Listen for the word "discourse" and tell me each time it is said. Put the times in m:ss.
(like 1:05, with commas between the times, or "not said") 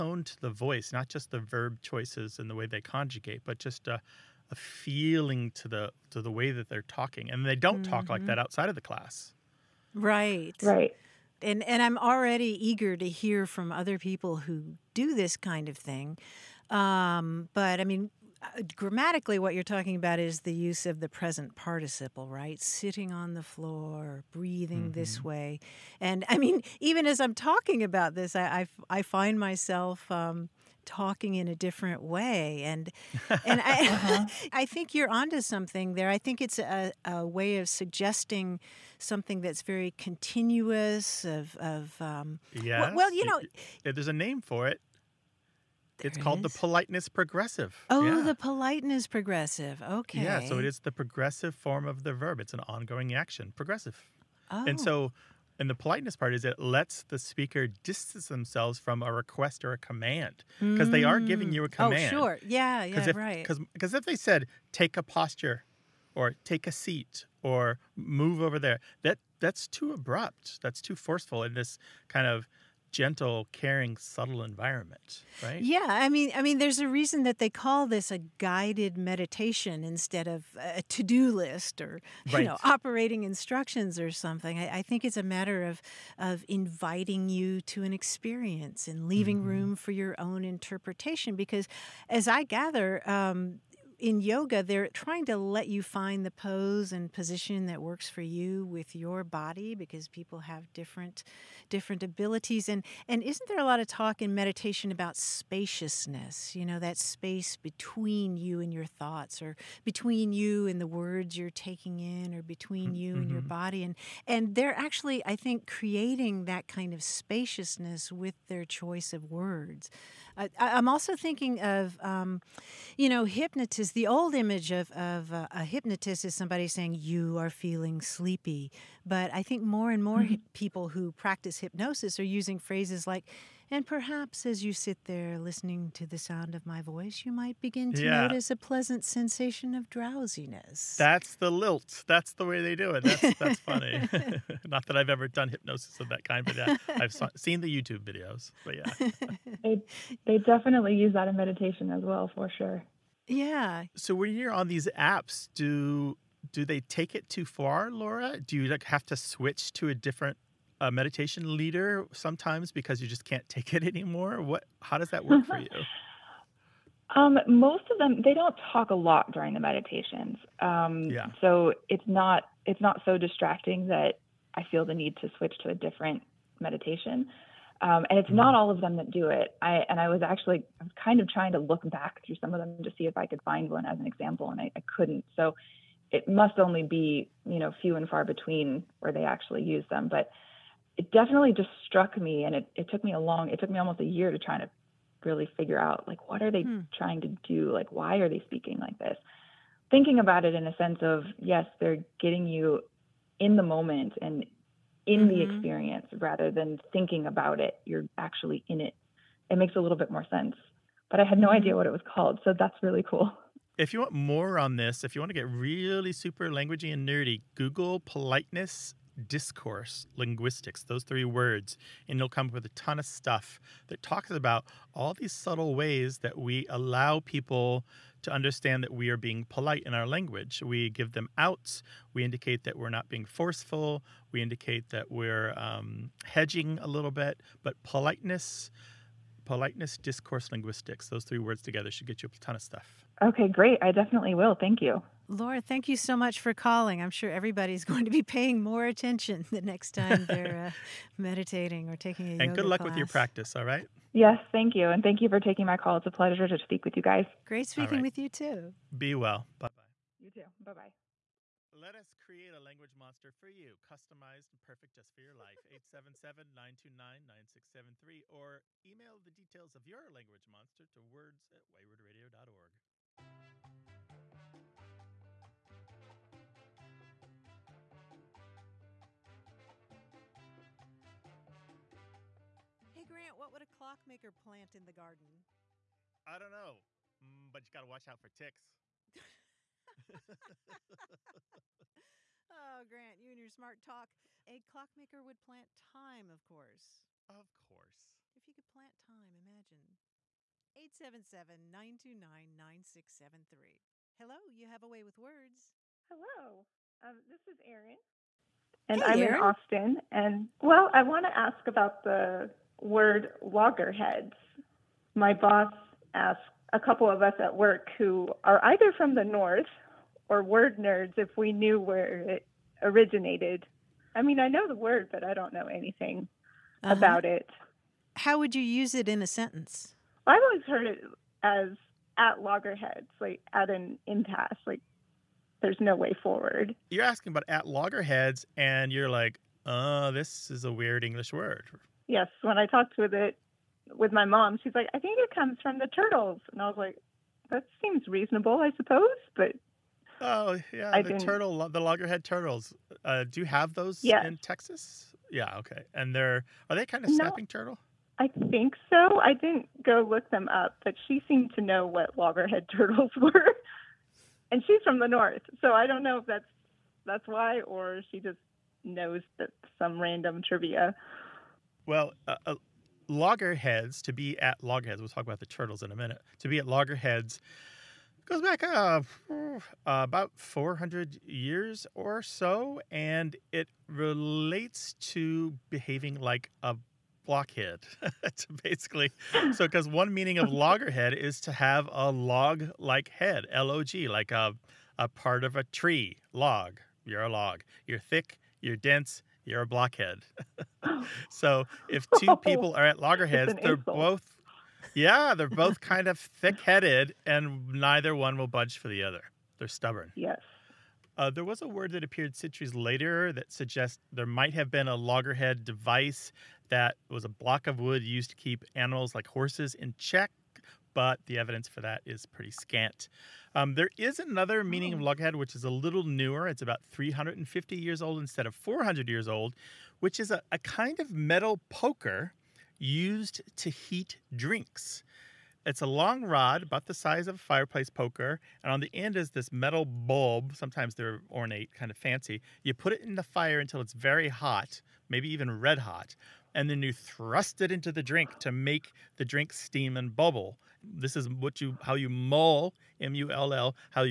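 3:39, 3:59.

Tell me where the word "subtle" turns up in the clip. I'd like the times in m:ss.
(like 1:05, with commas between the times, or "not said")
1:13, 3:45.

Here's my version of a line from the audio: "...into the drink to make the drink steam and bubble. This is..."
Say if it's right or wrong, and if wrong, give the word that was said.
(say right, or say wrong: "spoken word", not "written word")
right.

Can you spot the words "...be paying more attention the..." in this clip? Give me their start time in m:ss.
4:08.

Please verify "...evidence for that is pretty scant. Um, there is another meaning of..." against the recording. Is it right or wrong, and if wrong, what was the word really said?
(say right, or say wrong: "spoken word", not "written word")
right.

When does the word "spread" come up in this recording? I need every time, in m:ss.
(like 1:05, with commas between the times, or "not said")
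not said.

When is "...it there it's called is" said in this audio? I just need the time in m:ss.
0:44.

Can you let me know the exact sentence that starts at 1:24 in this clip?
I, I, think it's a matter of of inviting you to an experience and leaving mm-hmm.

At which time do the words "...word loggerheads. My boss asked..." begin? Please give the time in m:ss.
5:12.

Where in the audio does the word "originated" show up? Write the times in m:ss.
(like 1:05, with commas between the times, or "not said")
5:22.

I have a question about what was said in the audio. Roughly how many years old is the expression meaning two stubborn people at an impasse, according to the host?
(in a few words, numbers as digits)
400 years.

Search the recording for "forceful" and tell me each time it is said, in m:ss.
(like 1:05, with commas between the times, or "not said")
1:10, 3:53.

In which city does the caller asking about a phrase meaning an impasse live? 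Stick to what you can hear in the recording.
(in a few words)
Austin.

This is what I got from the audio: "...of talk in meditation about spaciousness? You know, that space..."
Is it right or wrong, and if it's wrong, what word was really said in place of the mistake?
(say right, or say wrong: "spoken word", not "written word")
right.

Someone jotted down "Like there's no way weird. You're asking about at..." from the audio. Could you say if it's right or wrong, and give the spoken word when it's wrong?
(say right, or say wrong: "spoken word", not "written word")
wrong: "forward", not "weird".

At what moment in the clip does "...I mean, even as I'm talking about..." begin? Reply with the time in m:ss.
0:26.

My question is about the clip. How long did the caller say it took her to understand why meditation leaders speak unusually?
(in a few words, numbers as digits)
almost a year.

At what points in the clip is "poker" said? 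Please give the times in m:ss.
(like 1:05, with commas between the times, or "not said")
7:11, 7:17.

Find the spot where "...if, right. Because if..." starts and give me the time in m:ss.
1:03.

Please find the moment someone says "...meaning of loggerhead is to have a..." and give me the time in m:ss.
6:30.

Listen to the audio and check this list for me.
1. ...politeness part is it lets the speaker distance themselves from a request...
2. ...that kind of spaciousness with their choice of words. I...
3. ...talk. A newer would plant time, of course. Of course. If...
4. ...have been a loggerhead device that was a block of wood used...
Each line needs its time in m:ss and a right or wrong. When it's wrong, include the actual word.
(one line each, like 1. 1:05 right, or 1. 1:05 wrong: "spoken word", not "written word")
1. 0:55 right
2. 1:56 right
3. 4:53 wrong: "clockmaker", not "newer"
4. 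6:54 right.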